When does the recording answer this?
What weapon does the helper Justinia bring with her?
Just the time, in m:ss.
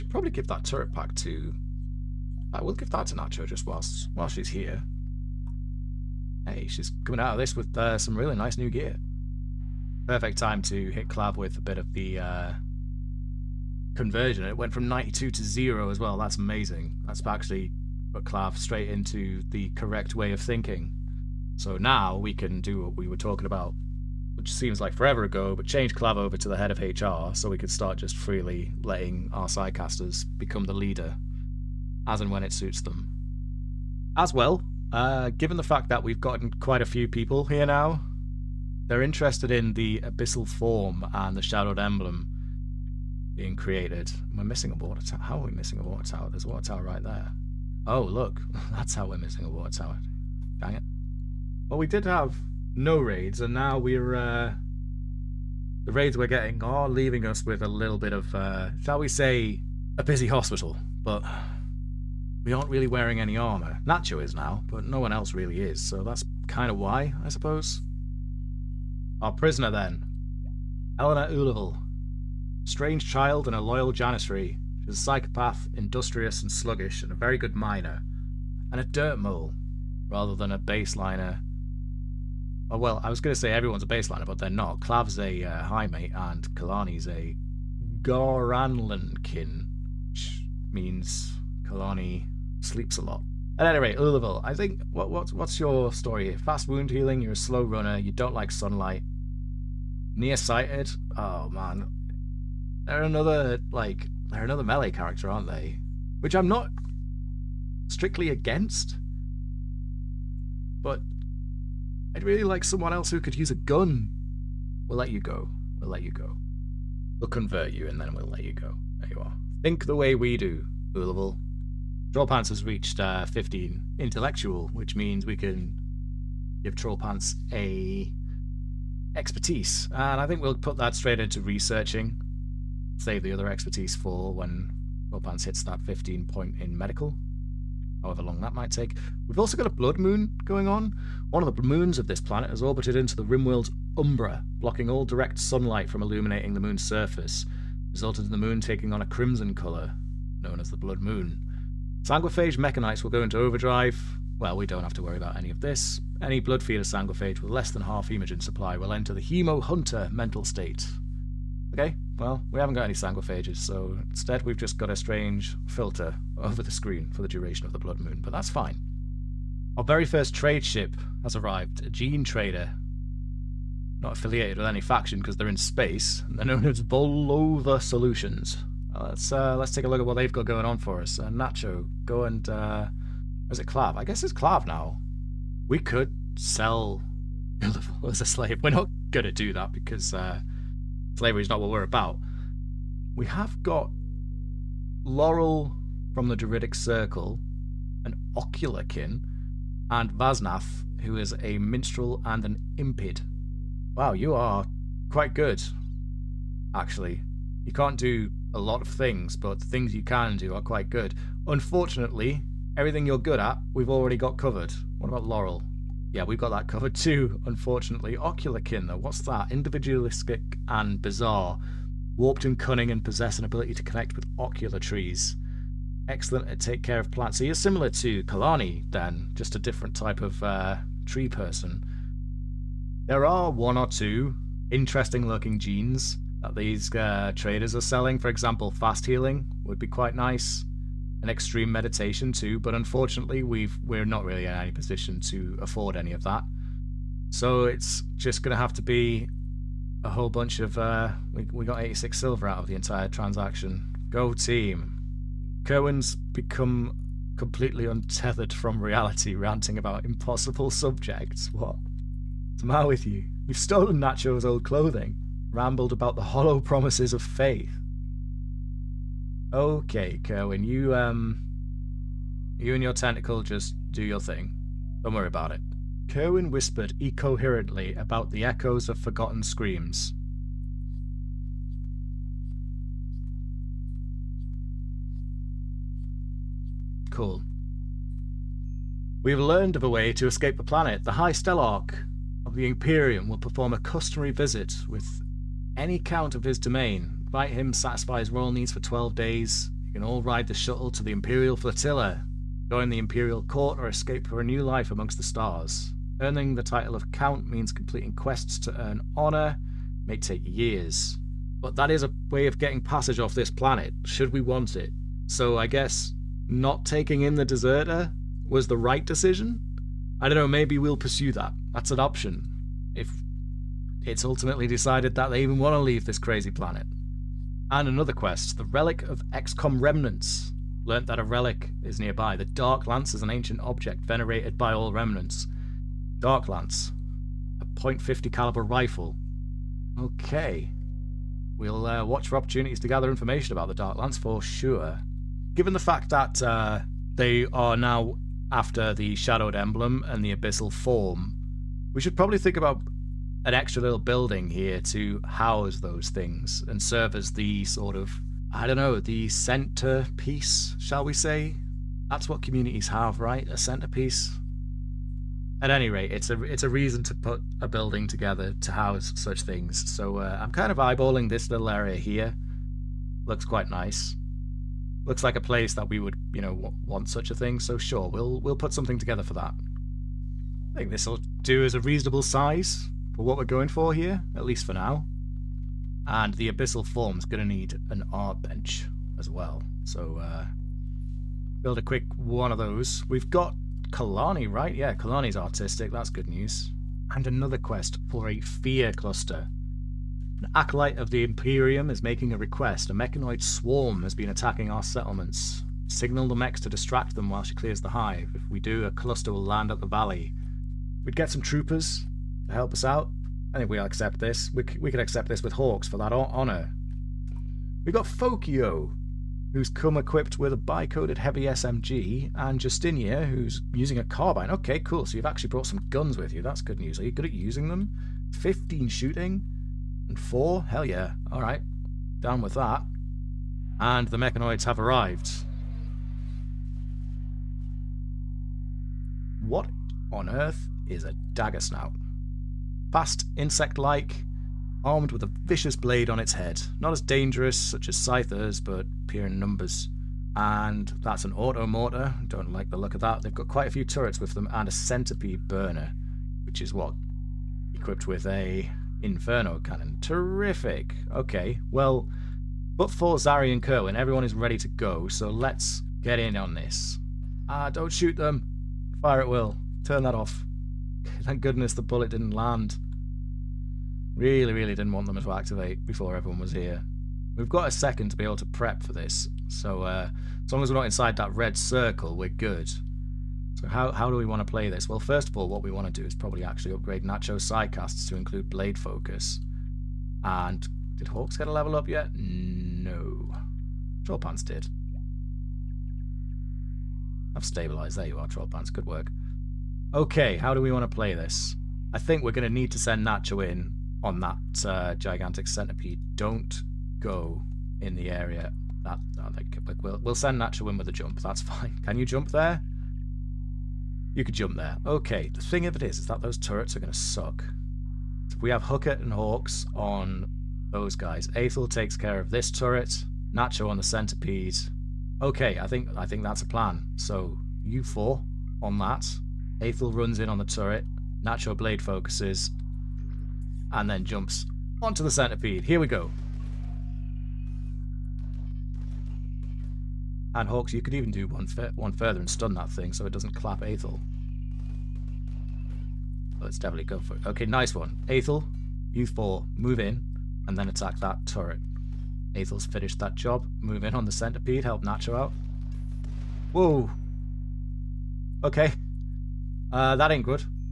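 7:04.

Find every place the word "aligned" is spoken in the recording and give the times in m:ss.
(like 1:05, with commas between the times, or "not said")
not said.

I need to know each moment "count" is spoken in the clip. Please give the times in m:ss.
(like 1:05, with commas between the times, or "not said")
4:55, 5:07.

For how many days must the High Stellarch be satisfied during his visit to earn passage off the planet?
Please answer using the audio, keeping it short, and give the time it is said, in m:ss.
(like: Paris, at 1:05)
12, at 4:58.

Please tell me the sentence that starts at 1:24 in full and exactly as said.
Clav's a uh, high mate, and Kalani's a Goranlankin, which means Kalani sleeps a lot.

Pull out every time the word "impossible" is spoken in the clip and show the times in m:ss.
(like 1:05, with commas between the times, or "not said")
4:20.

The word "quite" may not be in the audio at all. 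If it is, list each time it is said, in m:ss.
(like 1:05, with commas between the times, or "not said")
0:36, 3:25, 3:30, 3:59, 6:13, 7:33.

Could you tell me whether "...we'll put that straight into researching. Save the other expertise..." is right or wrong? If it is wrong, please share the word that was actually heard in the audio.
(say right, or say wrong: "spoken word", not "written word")
right.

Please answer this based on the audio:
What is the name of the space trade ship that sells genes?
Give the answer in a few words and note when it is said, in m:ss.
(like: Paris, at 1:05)
Volova Solutions, at 2:56.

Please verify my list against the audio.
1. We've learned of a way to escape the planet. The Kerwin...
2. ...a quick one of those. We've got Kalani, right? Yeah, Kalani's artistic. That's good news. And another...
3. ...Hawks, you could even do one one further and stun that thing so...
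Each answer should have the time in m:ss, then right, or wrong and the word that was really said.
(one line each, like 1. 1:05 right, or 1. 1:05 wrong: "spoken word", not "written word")
1. 4:49 wrong: "High", not "Kerwin"
2. 6:31 right
3. 9:00 right.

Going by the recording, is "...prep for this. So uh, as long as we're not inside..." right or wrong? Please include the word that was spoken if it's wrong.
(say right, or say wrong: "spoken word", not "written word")
right.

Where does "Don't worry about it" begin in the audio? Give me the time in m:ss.
4:35.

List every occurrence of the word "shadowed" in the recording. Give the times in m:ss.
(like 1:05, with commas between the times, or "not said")
0:41, 5:49.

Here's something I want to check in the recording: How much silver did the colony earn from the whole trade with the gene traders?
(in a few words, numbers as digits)
86.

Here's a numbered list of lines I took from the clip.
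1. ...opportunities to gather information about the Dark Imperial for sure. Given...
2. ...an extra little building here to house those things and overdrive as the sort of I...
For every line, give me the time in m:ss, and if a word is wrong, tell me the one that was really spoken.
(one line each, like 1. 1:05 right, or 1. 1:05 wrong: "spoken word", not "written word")
1. 5:42 wrong: "Lance", not "Imperial"
2. 5:53 wrong: "serve", not "overdrive".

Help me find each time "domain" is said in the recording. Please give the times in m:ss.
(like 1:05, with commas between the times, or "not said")
4:56.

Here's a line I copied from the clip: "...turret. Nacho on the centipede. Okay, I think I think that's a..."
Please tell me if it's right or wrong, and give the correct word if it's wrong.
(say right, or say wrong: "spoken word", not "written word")
right.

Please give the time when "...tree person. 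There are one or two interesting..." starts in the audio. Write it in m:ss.
3:51.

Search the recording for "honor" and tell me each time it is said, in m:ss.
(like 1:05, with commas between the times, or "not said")
5:09, 6:56.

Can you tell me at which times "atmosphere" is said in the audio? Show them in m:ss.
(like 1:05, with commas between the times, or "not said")
not said.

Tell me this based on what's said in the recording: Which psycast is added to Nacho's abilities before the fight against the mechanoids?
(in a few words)
Blade Focus.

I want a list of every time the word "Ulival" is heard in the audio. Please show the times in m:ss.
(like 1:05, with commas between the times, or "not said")
1:11, 2:00.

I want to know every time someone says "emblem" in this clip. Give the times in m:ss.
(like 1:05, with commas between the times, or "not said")
0:41, 5:49.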